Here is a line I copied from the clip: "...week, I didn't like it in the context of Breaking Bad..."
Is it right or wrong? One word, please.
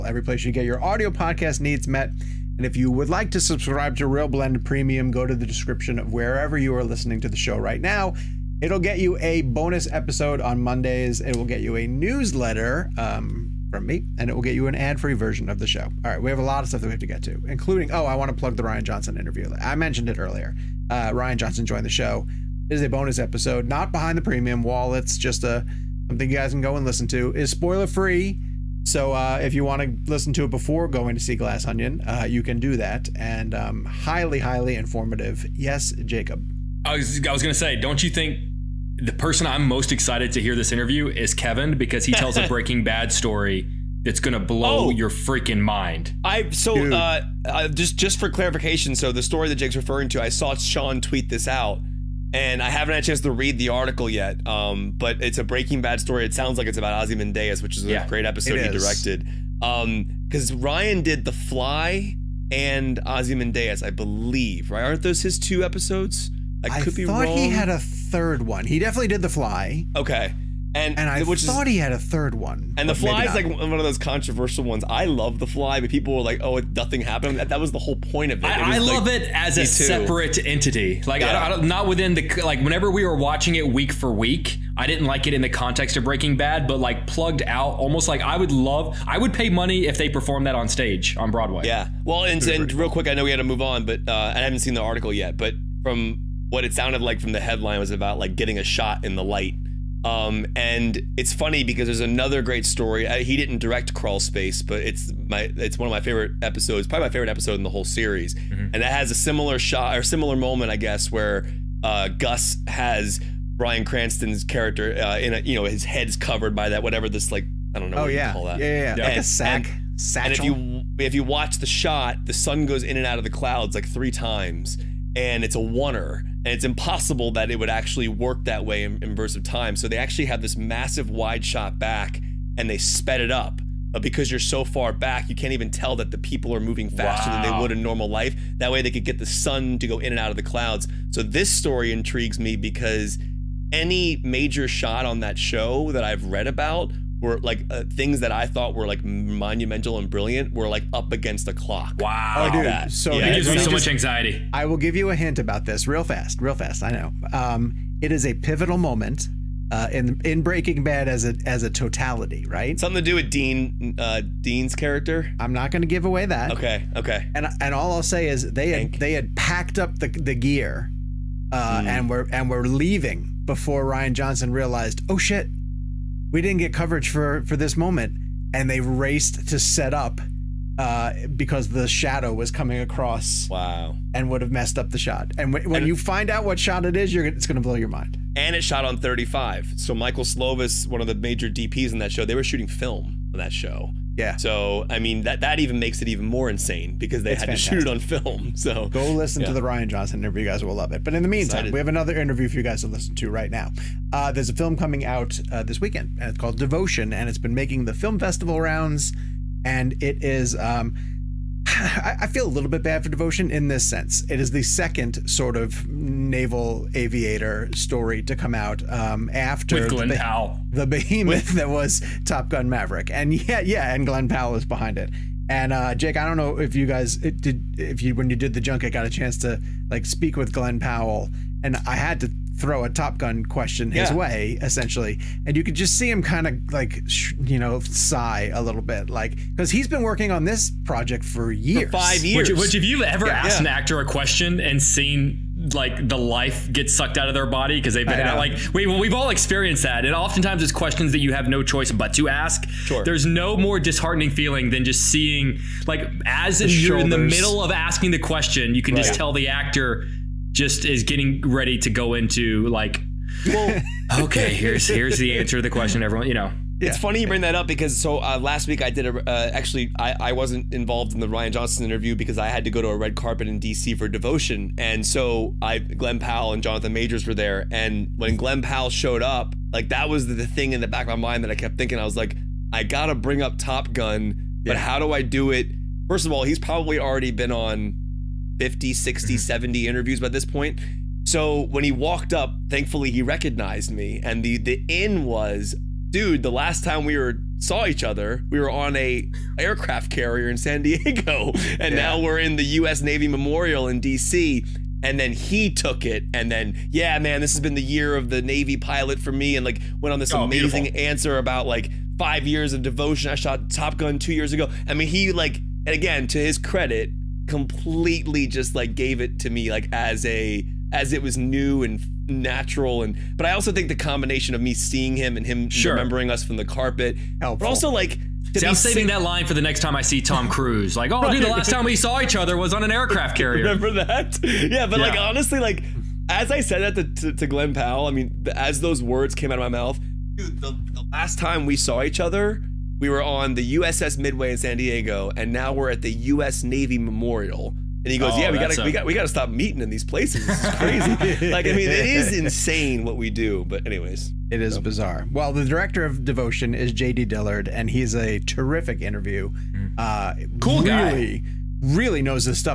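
right.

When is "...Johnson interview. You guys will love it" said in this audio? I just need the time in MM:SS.
03:19.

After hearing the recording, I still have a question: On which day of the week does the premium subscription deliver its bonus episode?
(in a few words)
Mondays.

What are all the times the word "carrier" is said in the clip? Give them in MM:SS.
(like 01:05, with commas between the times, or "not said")
05:00, 05:33.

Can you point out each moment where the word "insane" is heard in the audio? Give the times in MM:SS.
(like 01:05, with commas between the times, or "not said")
03:16, 05:52.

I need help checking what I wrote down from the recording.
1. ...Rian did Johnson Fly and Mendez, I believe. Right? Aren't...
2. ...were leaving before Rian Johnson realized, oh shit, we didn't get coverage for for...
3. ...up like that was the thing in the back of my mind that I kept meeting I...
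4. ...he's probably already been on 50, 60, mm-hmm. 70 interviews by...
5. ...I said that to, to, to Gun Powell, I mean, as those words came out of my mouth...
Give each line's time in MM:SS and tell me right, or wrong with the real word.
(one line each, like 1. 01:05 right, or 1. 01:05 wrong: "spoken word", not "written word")
1. 01:00 wrong: "The", not "Johnson"
2. 02:52 right
3. 04:39 wrong: "thinking", not "meeting"
4. 04:46 right
5. 05:36 wrong: "Glen", not "Gun".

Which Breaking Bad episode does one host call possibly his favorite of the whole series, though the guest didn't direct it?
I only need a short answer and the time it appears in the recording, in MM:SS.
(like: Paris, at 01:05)
Crawl Space, at 01:43.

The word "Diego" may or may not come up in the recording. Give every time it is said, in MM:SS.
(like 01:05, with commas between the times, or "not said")
05:00, 05:44.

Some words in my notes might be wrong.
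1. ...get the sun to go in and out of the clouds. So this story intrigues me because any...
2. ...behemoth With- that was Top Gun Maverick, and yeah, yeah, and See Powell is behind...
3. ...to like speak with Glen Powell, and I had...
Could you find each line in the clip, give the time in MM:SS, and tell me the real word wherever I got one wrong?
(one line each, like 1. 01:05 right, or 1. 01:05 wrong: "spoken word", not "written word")
1. 02:19 right
2. 03:40 wrong: "Glen", not "See"
3. 03:49 right.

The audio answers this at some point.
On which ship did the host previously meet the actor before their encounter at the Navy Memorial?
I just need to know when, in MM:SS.
05:43.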